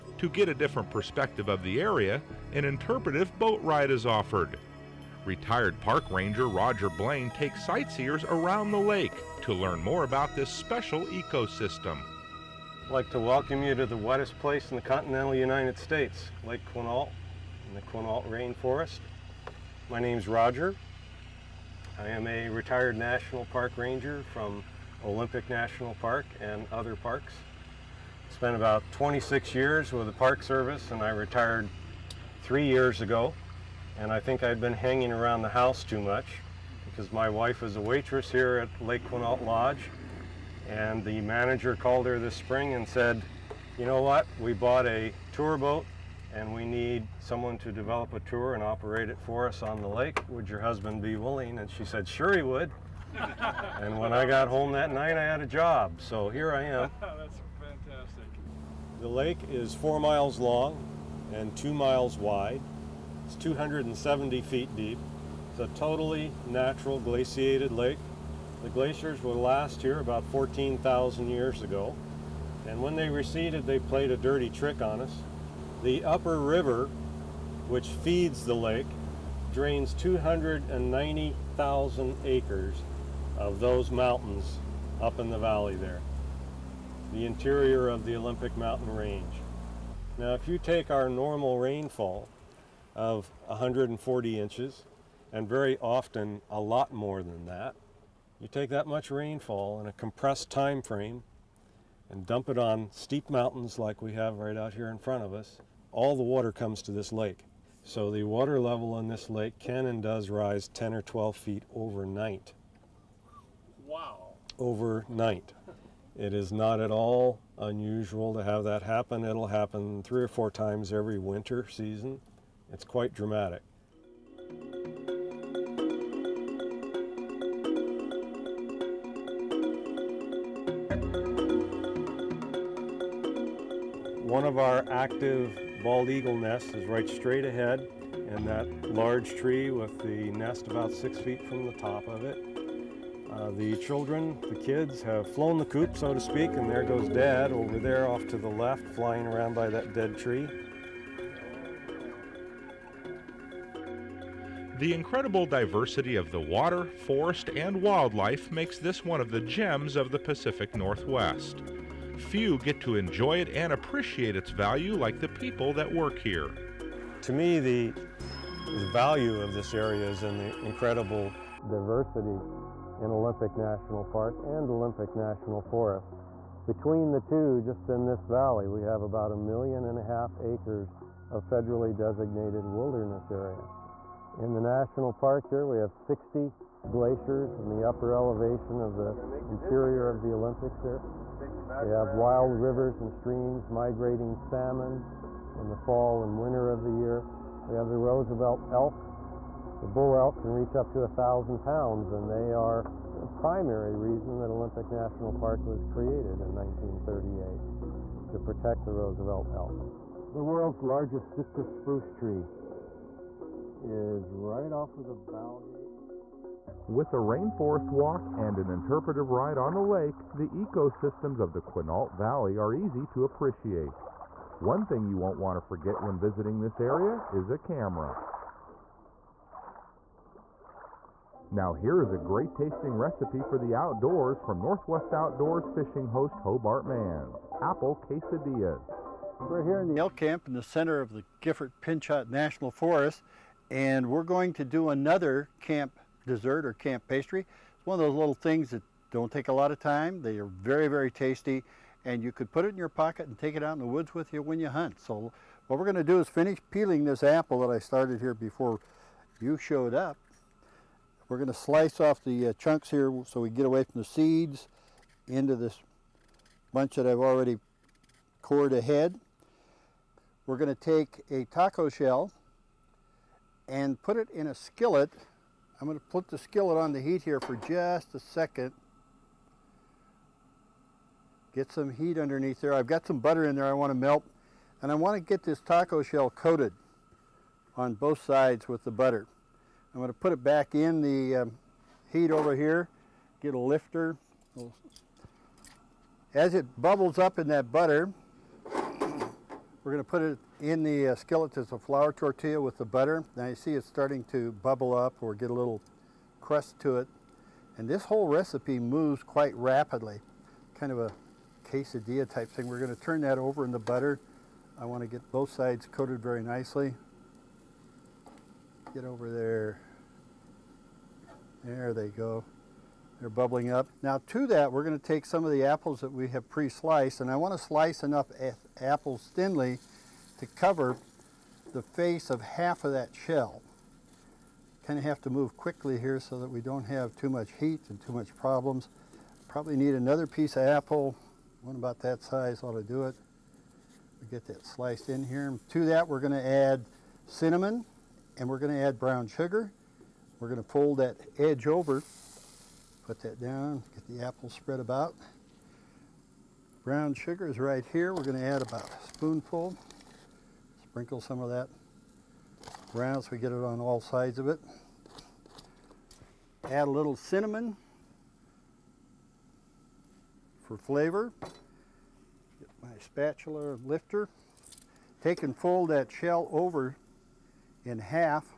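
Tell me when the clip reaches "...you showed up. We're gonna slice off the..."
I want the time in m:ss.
4:19.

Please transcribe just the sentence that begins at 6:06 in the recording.
Add a little cinnamon for flavor.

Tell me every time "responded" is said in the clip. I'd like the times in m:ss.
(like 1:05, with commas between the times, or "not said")
not said.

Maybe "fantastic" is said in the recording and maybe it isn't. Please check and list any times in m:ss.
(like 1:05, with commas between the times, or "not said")
0:57.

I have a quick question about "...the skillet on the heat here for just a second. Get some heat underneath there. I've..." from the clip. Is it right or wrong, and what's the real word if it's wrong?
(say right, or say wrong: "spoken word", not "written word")
right.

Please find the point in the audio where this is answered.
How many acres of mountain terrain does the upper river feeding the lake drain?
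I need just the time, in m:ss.
1:19.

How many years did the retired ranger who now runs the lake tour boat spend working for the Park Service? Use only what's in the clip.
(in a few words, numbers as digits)
26 years.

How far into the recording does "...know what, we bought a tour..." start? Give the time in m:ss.
0:43.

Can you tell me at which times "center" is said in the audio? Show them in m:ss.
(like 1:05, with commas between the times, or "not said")
4:00.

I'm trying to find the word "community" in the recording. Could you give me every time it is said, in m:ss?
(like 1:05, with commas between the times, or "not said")
not said.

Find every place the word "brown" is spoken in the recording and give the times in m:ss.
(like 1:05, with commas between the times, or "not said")
5:48, 5:56, 6:02.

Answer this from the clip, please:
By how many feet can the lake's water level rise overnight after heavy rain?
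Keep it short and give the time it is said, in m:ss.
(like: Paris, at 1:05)
10 or 12 feet, at 1:50.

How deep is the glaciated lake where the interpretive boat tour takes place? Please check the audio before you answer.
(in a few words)
270 feet.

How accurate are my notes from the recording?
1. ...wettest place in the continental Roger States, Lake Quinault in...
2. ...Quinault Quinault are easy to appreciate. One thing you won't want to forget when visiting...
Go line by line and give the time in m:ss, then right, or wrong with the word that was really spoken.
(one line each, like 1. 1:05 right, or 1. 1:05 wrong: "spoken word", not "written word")
1. 0:13 wrong: "United", not "Roger"
2. 3:41 wrong: "Valley", not "Quinault".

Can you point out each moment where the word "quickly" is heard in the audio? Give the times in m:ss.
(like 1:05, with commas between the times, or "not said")
5:35.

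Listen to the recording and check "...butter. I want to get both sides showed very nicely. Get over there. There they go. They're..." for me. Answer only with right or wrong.
wrong.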